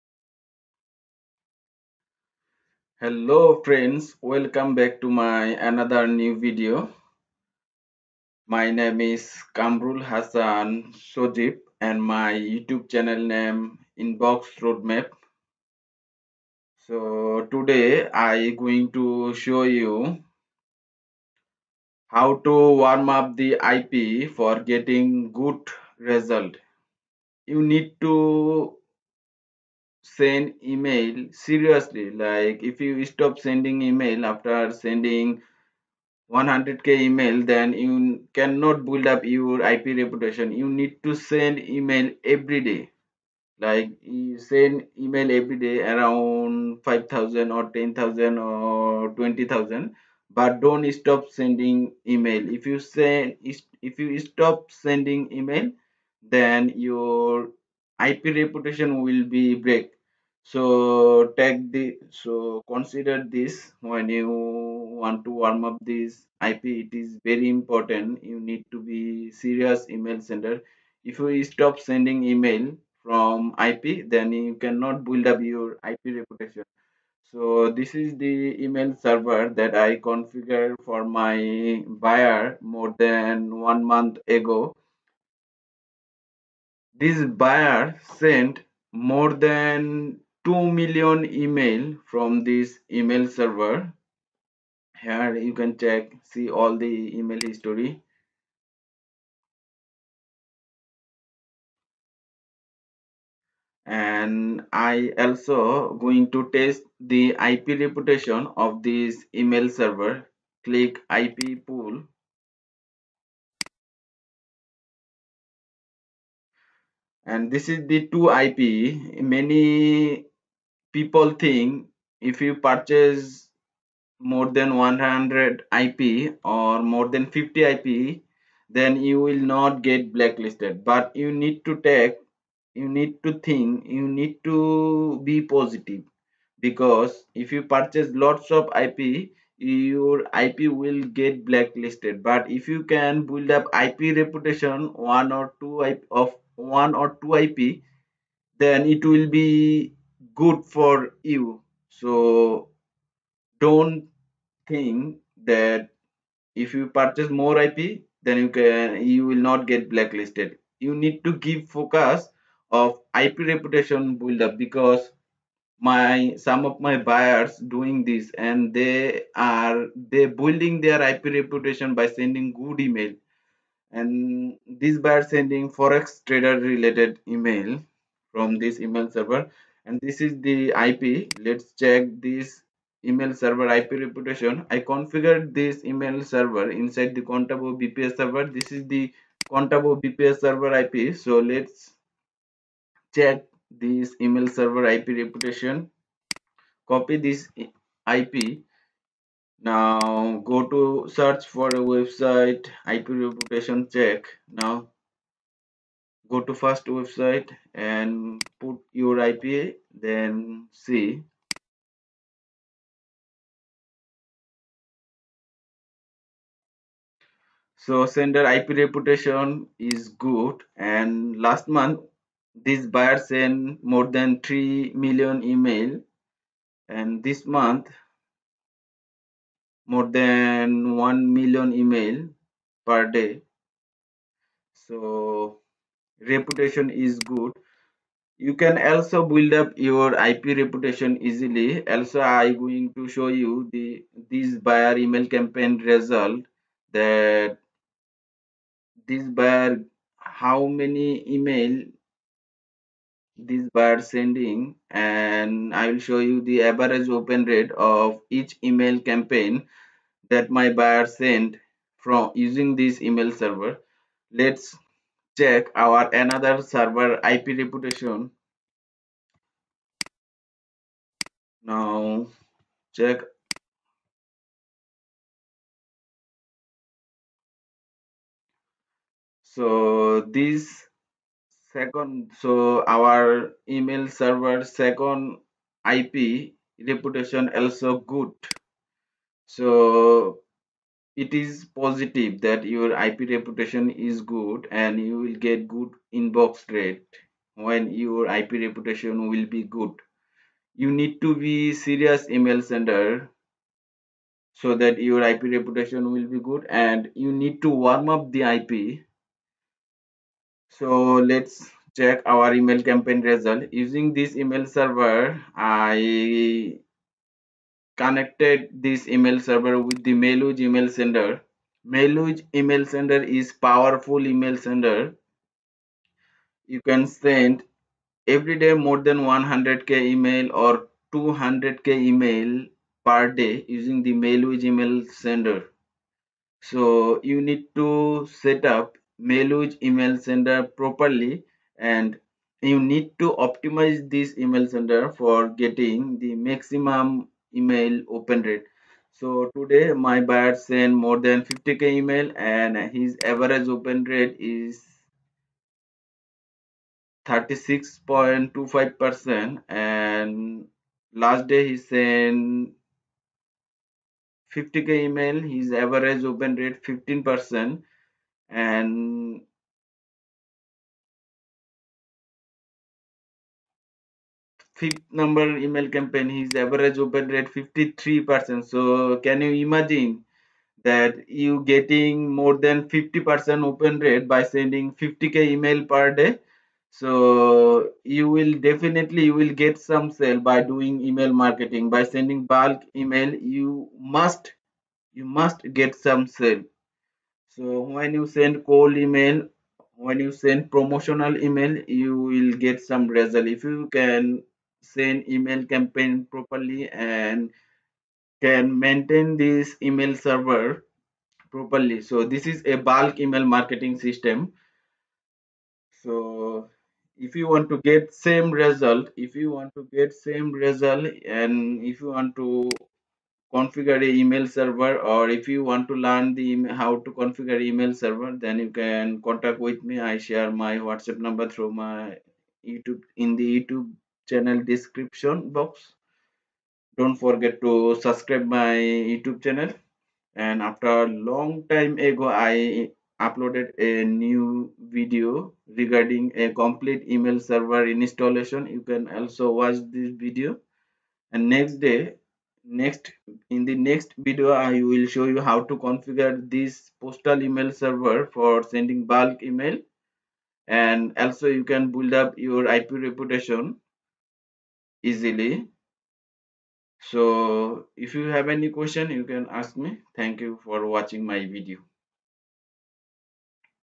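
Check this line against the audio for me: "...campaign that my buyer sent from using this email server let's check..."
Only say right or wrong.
right.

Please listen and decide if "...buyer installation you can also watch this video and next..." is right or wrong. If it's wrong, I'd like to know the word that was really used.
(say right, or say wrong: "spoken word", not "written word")
wrong: "server", not "buyer".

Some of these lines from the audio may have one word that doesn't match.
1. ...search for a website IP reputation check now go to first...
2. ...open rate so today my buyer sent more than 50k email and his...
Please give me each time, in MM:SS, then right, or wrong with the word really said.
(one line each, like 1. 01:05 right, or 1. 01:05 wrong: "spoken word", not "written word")
1. 03:21 right
2. 05:48 right.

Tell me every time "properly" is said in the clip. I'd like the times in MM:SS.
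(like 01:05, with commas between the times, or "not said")
05:40, 06:46, 06:51.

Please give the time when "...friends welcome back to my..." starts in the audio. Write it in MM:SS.
00:03.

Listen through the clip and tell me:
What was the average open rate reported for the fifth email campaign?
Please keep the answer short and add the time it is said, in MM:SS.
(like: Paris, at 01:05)
53%, at 06:17.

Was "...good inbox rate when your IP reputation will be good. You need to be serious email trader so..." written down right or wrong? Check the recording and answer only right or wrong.
wrong.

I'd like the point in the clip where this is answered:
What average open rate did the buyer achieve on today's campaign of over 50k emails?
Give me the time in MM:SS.
05:57.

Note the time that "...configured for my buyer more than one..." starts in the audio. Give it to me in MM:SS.
01:19.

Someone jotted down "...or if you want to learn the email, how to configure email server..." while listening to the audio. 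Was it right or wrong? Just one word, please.
right.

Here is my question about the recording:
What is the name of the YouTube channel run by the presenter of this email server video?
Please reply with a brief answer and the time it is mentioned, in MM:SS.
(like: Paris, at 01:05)
Inbox Roadmap, at 00:14.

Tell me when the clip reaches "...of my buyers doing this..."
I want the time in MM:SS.
02:46.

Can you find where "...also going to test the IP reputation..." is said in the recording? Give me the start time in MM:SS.
01:45.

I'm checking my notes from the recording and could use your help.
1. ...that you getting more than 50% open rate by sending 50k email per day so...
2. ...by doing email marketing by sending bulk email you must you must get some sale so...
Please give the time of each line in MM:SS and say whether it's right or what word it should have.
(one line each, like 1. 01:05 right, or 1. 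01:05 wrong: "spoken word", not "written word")
1. 06:20 right
2. 06:30 right.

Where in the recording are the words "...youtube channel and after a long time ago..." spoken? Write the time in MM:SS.
07:18.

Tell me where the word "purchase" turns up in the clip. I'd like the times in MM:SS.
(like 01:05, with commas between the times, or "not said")
02:02, 02:17, 02:36.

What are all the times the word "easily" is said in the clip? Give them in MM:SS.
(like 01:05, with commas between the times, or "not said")
04:01, 07:45.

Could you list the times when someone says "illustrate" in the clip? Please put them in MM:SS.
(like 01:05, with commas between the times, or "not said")
not said.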